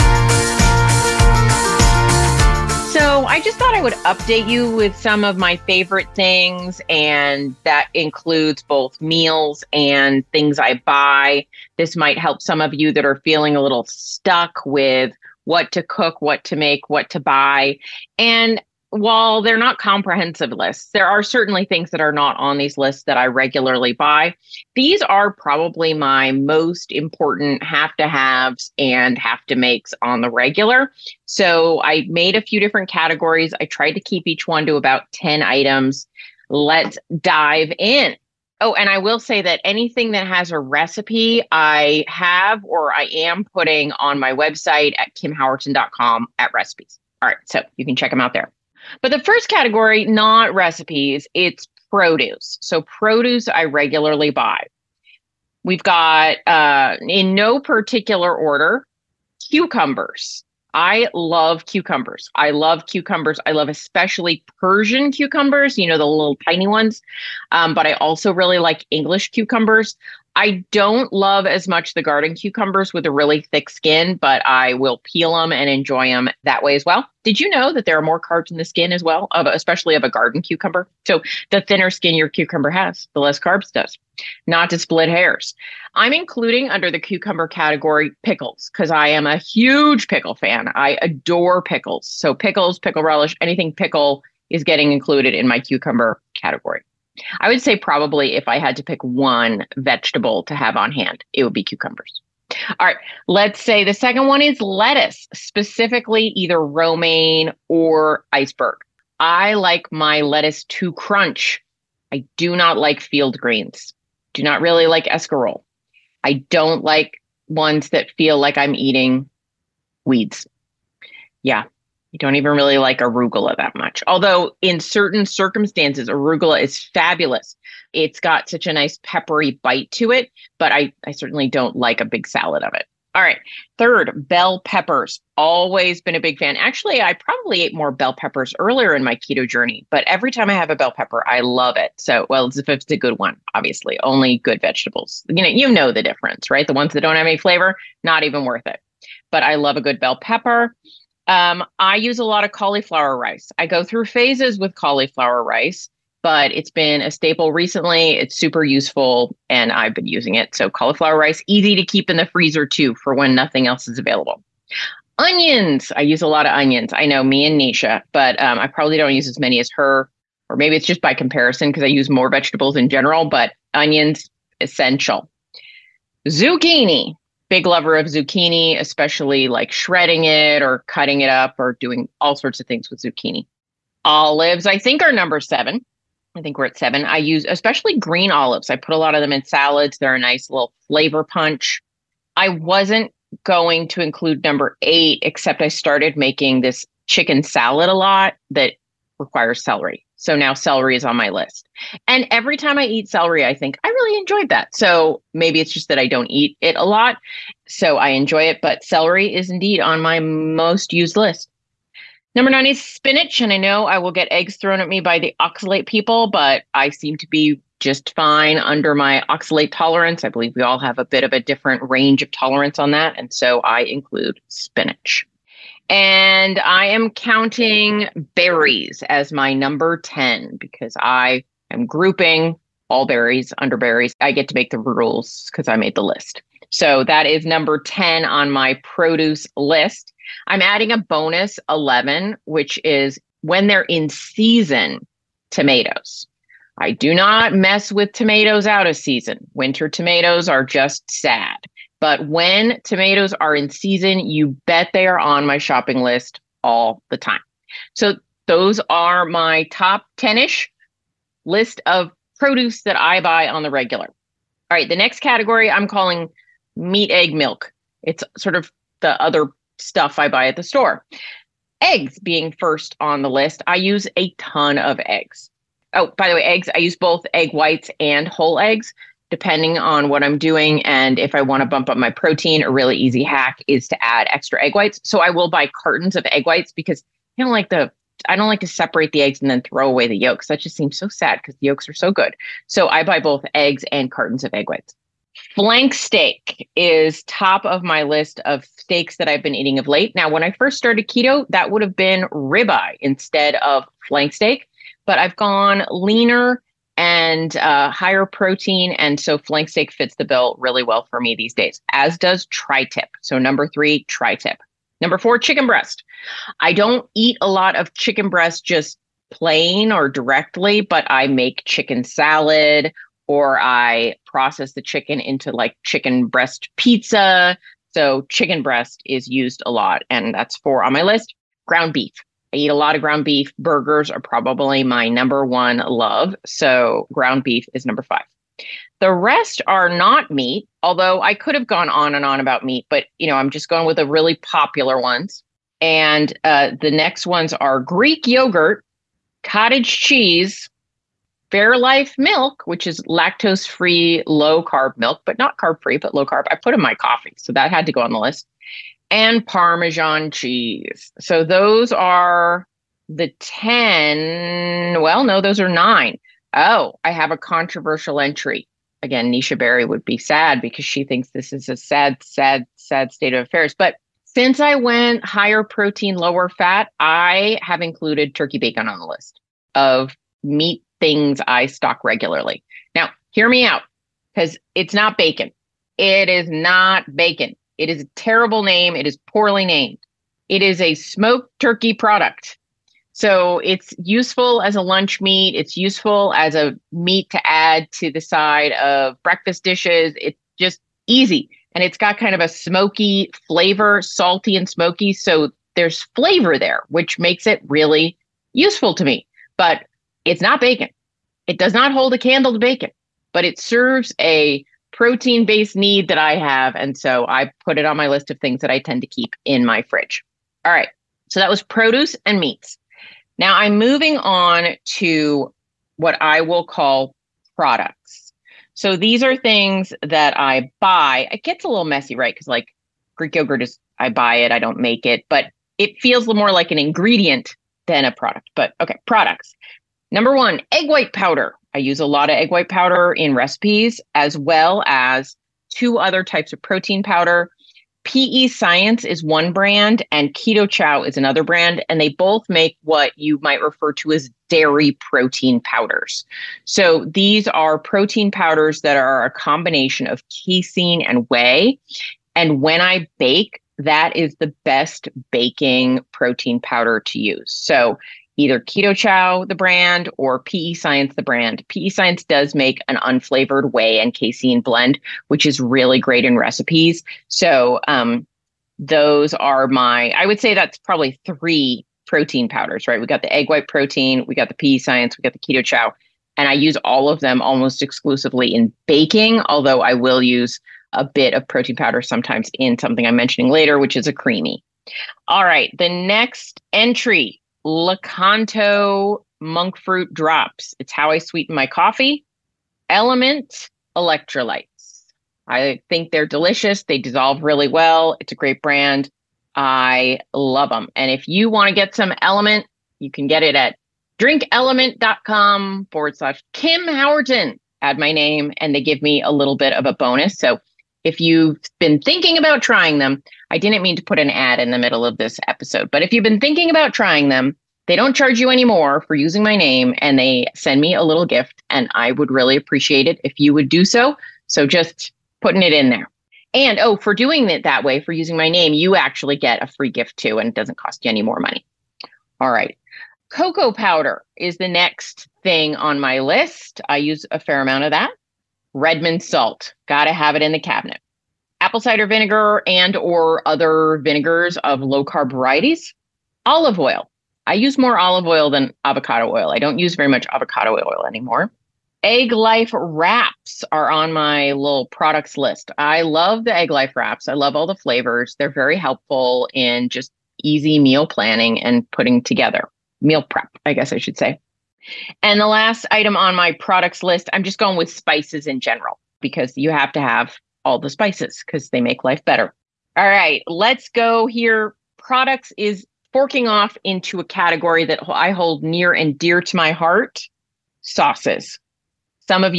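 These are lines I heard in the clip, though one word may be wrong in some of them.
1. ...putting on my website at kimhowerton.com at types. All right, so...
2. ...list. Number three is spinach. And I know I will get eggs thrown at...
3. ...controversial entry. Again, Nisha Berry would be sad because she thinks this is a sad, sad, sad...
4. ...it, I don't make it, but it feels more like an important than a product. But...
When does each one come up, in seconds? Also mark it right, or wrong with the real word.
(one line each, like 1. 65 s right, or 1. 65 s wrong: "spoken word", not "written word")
1. 43 s wrong: "recipes", not "types"
2. 211 s wrong: "nine", not "three"
3. 367 s right
4. 434 s wrong: "ingredient", not "important".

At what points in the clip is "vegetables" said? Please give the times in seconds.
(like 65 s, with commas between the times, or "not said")
99 s, 144 s, 172 s.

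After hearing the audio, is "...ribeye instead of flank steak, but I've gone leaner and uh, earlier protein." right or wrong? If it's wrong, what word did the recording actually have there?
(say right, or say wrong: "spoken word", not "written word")
wrong: "higher", not "earlier".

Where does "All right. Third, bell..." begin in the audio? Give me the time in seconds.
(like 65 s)
133 s.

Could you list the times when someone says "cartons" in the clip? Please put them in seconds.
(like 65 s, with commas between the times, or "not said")
285 s, 294 s.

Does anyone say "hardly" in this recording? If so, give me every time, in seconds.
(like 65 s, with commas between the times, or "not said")
not said.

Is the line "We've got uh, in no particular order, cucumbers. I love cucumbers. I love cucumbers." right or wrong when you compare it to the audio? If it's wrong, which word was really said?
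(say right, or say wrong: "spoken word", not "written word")
right.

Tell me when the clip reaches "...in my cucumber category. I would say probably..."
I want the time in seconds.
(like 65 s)
95 s.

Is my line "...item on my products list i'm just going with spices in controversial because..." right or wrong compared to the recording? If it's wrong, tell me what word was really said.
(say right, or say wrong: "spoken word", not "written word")
wrong: "general", not "controversial".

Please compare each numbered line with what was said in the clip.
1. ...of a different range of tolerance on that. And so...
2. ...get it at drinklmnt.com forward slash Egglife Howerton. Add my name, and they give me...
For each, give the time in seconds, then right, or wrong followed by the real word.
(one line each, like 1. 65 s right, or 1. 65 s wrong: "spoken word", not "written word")
1. 221 s right
2. 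513 s wrong: "Kim", not "Egglife".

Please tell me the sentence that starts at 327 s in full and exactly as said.
So, chicken breast is used a lot, and that's four on my list.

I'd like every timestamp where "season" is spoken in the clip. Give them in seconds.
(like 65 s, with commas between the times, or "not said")
244 s, 248 s, 253 s.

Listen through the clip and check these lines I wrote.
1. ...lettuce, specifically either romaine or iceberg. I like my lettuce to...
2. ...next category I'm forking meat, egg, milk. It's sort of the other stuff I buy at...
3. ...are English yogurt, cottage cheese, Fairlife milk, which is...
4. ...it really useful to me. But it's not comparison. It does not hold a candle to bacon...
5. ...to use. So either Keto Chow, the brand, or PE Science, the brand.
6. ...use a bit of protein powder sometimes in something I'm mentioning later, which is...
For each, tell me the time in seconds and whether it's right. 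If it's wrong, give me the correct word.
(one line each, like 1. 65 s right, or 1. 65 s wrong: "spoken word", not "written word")
1. 104 s right
2. 264 s wrong: "calling", not "forking"
3. 347 s wrong: "Greek", not "English"
4. 407 s wrong: "bacon", not "comparison"
5. 467 s right
6. 490 s right.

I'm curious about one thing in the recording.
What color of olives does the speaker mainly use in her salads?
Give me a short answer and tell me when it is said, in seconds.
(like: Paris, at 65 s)
green, at 187 s.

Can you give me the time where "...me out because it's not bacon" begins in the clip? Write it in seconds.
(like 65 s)
383 s.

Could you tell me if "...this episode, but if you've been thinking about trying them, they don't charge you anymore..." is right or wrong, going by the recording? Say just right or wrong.
right.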